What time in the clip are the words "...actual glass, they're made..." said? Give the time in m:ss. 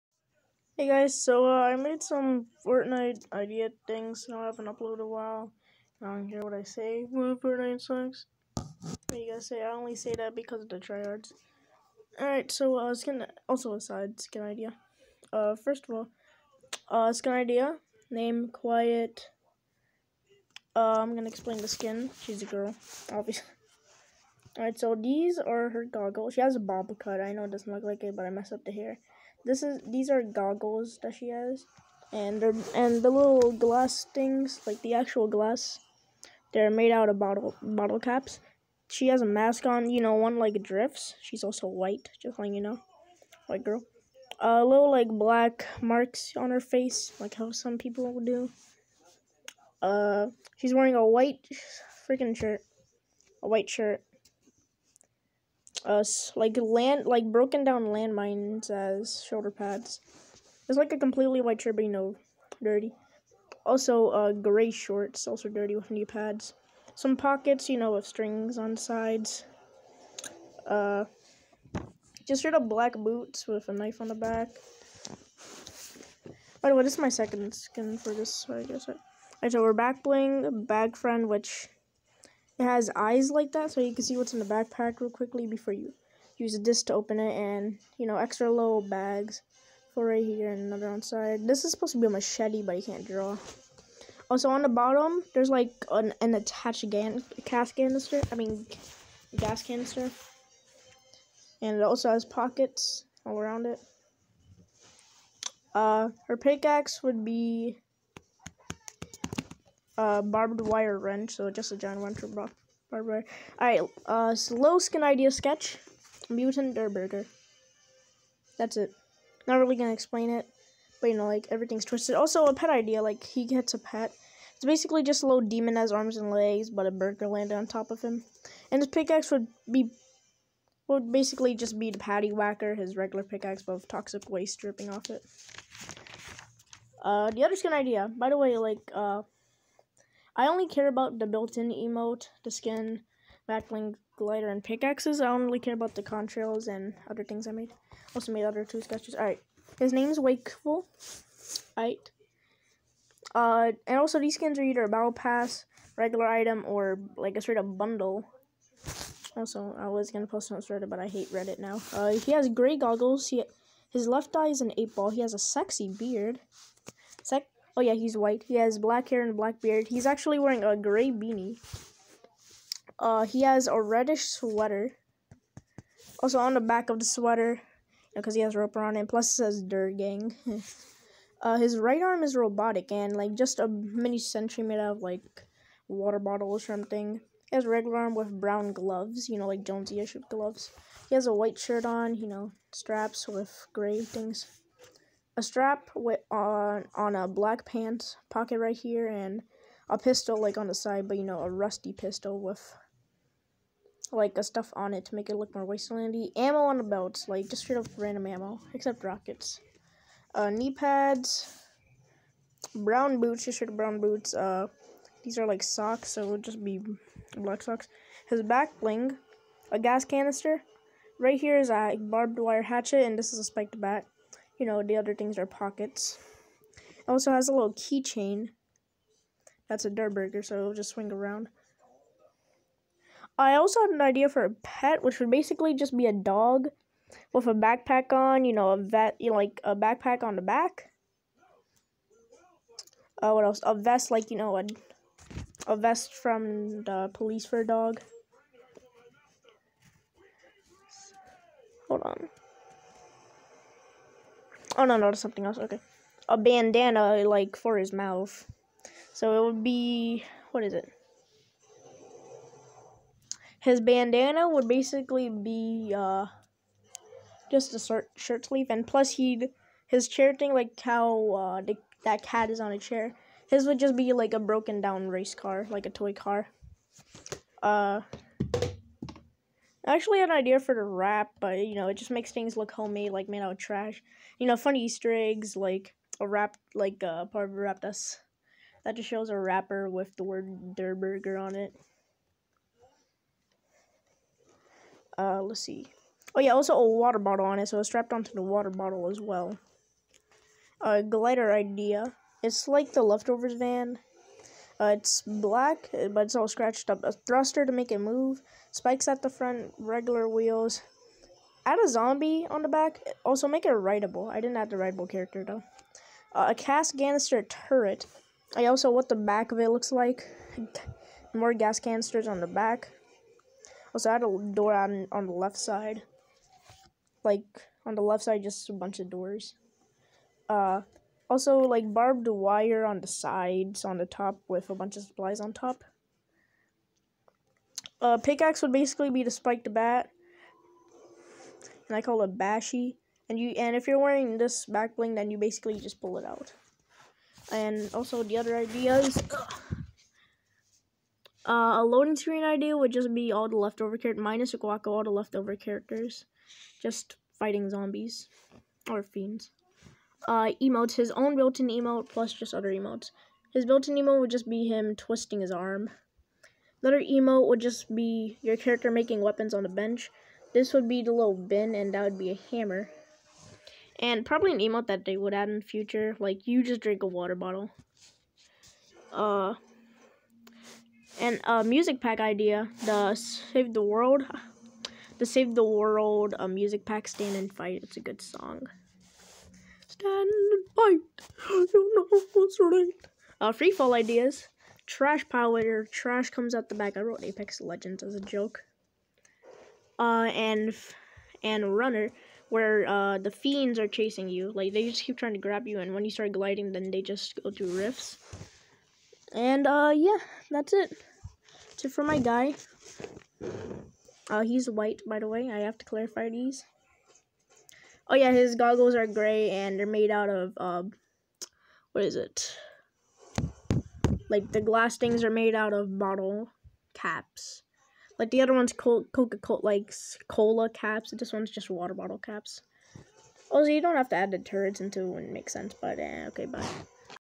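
0:34.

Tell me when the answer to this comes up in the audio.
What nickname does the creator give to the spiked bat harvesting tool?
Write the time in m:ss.
5:42.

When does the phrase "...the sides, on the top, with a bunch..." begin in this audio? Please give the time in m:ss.
5:32.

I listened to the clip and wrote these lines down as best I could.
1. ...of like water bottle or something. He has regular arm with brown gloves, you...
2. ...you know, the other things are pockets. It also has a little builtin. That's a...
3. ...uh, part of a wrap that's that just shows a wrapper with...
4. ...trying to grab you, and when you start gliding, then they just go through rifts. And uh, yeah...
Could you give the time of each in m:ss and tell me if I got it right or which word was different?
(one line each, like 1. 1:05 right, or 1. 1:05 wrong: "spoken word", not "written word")
1. 3:04 right
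2. 3:44 wrong: "keychain", not "builtin"
3. 4:47 right
4. 6:45 right.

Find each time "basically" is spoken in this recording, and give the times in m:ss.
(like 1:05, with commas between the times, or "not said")
2:04, 2:11, 3:55, 4:24, 5:38, 5:45.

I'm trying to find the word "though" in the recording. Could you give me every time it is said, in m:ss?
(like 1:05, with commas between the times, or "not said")
5:15.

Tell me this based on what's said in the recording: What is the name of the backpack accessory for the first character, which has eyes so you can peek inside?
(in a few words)
Bag Friend.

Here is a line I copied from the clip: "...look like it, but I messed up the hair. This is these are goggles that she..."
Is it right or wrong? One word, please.
right.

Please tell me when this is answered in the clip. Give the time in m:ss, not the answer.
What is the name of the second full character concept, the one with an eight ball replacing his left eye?
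2:30.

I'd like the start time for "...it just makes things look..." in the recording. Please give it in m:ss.
4:41.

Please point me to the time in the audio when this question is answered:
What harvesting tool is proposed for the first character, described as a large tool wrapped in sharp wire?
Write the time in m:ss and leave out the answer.
1:50.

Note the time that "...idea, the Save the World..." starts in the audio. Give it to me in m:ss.
6:22.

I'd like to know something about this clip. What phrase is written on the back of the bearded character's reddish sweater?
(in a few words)
Dirt Gang.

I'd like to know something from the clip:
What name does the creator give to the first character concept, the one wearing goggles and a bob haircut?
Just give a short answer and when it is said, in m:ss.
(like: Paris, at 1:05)
Quiet, at 0:18.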